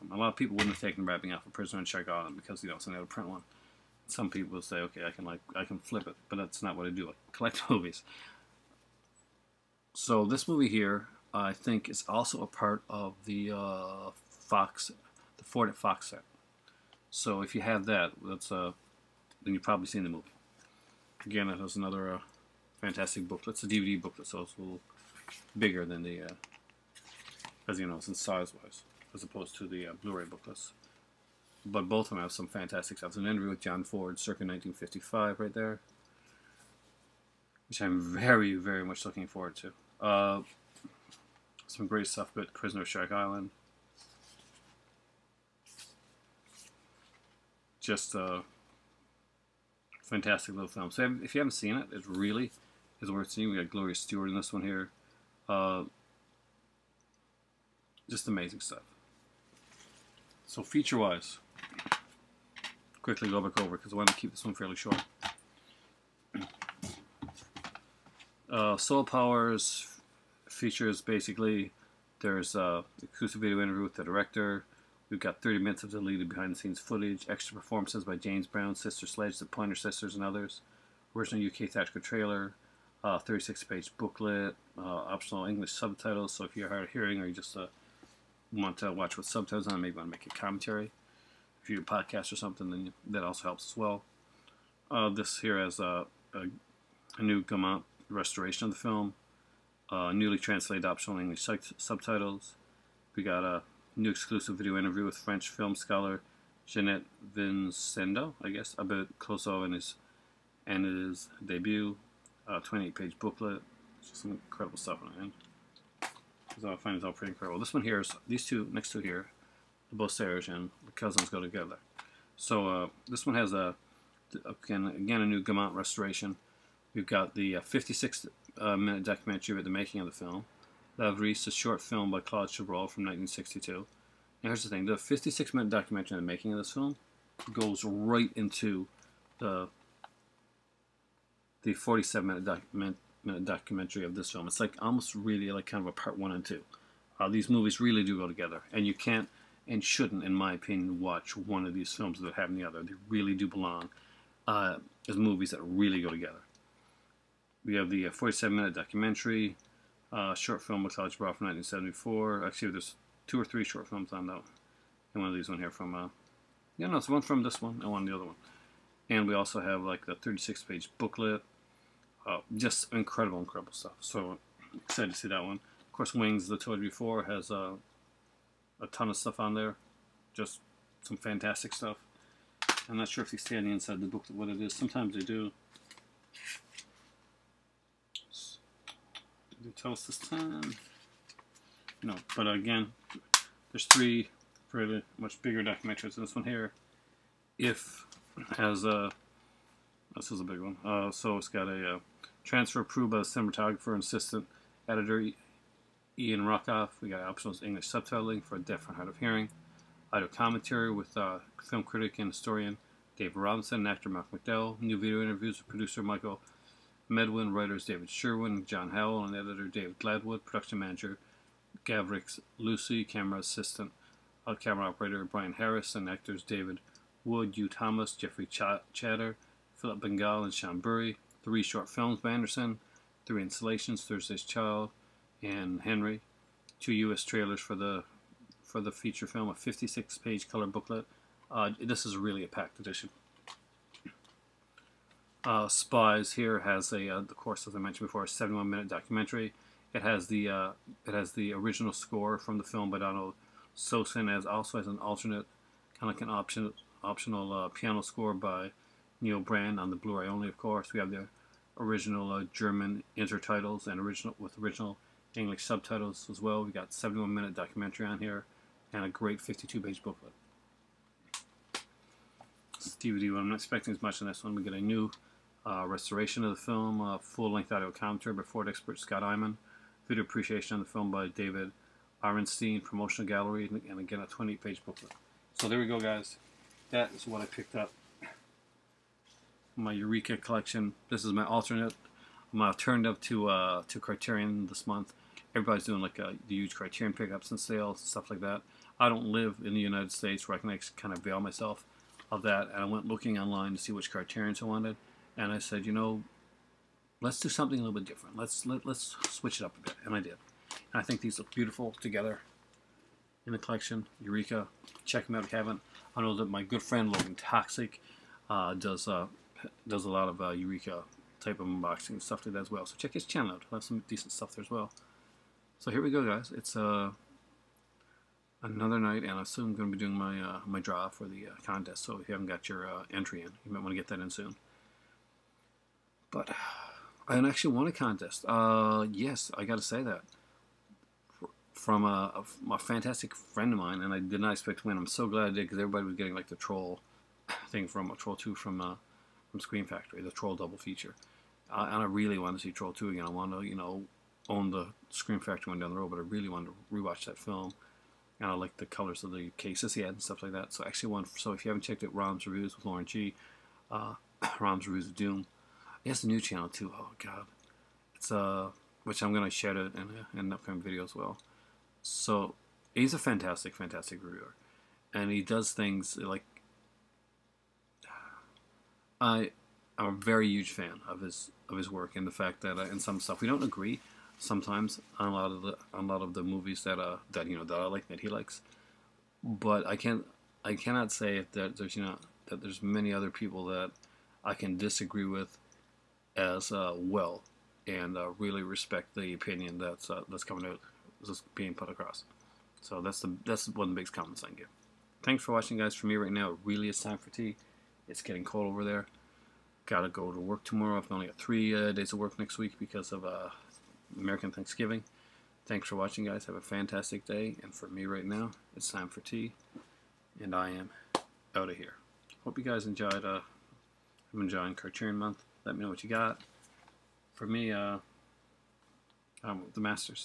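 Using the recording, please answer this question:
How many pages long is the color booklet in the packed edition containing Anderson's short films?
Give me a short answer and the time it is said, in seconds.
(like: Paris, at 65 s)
56, at 239 s.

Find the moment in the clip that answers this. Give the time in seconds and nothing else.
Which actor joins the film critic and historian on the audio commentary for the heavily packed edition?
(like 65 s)
214 s.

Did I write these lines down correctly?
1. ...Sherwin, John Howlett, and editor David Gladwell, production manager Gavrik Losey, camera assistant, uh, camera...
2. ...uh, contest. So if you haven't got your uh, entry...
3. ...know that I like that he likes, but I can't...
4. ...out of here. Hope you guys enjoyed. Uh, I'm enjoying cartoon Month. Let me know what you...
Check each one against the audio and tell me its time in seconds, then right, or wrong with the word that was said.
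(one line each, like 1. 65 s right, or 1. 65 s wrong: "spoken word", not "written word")
1. 218 s right
2. 331 s right
3. 387 s right
4. 421 s right.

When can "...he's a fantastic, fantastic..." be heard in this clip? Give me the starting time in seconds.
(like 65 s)
372 s.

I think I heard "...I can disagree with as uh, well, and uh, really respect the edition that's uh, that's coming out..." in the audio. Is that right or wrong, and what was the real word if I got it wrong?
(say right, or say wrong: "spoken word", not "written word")
wrong: "opinion", not "edition".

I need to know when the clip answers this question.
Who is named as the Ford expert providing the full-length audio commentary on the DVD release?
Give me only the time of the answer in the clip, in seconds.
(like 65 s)
278 s.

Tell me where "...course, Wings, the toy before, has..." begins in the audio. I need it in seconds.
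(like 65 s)
175 s.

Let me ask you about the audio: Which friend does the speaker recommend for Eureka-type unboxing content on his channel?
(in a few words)
Logan Toxic.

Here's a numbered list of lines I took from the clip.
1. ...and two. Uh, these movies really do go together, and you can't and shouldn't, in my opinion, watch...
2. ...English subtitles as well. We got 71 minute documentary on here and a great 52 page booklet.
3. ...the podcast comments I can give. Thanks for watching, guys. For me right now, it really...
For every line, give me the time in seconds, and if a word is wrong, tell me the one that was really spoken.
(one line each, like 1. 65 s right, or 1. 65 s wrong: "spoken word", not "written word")
1. 146 s right
2. 265 s right
3. 403 s wrong: "biggest", not "podcast".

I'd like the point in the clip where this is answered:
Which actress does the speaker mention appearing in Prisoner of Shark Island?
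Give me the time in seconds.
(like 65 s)
53 s.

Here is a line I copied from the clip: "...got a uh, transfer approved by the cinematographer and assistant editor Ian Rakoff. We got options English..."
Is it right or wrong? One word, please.
right.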